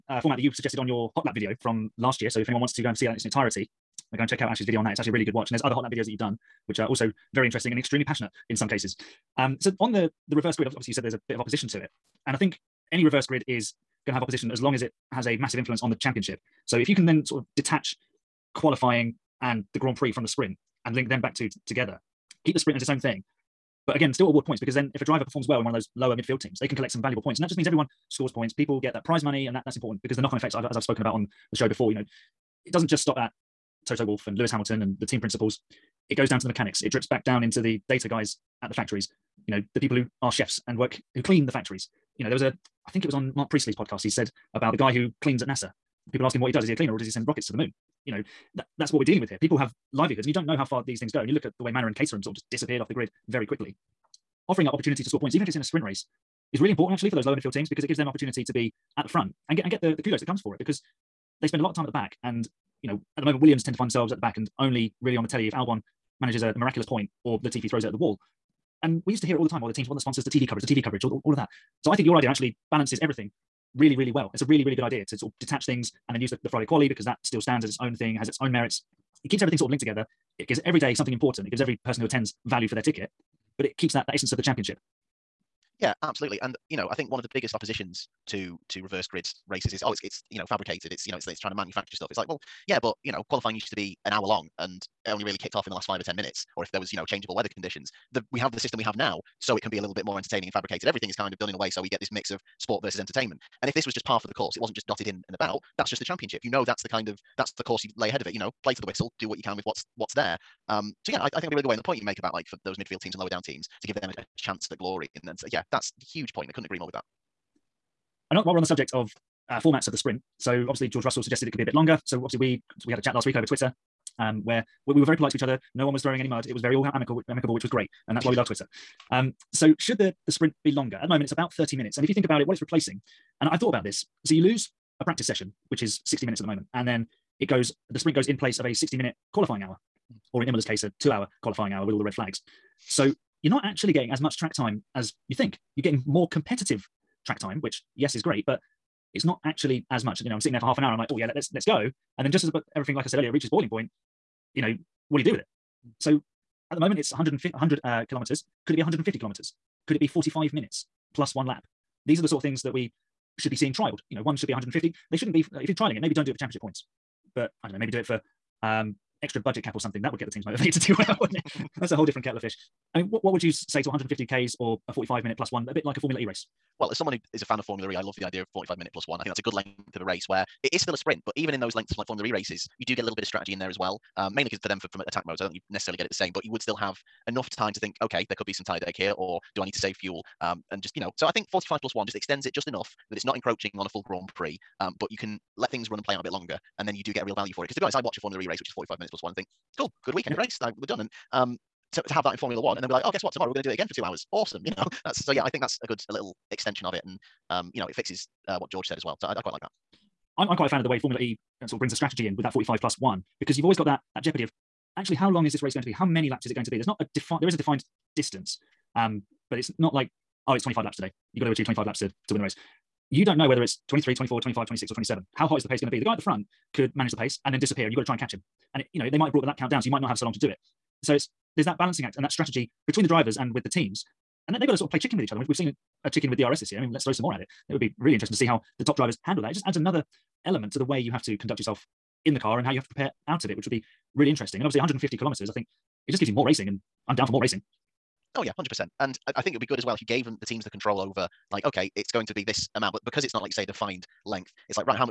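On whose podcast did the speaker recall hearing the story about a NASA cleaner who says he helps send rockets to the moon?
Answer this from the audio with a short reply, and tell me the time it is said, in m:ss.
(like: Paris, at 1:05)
Marc Priestley, at 0:43.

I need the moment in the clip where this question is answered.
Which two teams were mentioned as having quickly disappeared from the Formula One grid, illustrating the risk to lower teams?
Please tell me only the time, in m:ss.
0:51.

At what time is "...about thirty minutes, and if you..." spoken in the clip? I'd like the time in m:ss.
2:11.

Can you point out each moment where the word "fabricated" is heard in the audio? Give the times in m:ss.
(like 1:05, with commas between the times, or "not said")
1:30, 1:40.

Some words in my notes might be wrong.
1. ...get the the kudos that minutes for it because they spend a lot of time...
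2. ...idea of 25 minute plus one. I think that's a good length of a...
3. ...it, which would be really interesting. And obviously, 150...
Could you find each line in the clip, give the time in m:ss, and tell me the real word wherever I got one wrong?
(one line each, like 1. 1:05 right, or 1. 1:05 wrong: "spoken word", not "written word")
1. 0:59 wrong: "comes", not "minutes"
2. 2:58 wrong: "45", not "25"
3. 4:03 right.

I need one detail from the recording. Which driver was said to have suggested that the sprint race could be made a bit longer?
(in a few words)
George Russell.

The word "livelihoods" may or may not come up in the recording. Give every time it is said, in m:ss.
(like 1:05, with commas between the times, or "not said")
0:49.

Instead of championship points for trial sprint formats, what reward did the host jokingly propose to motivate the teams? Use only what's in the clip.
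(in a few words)
Extra budget cap.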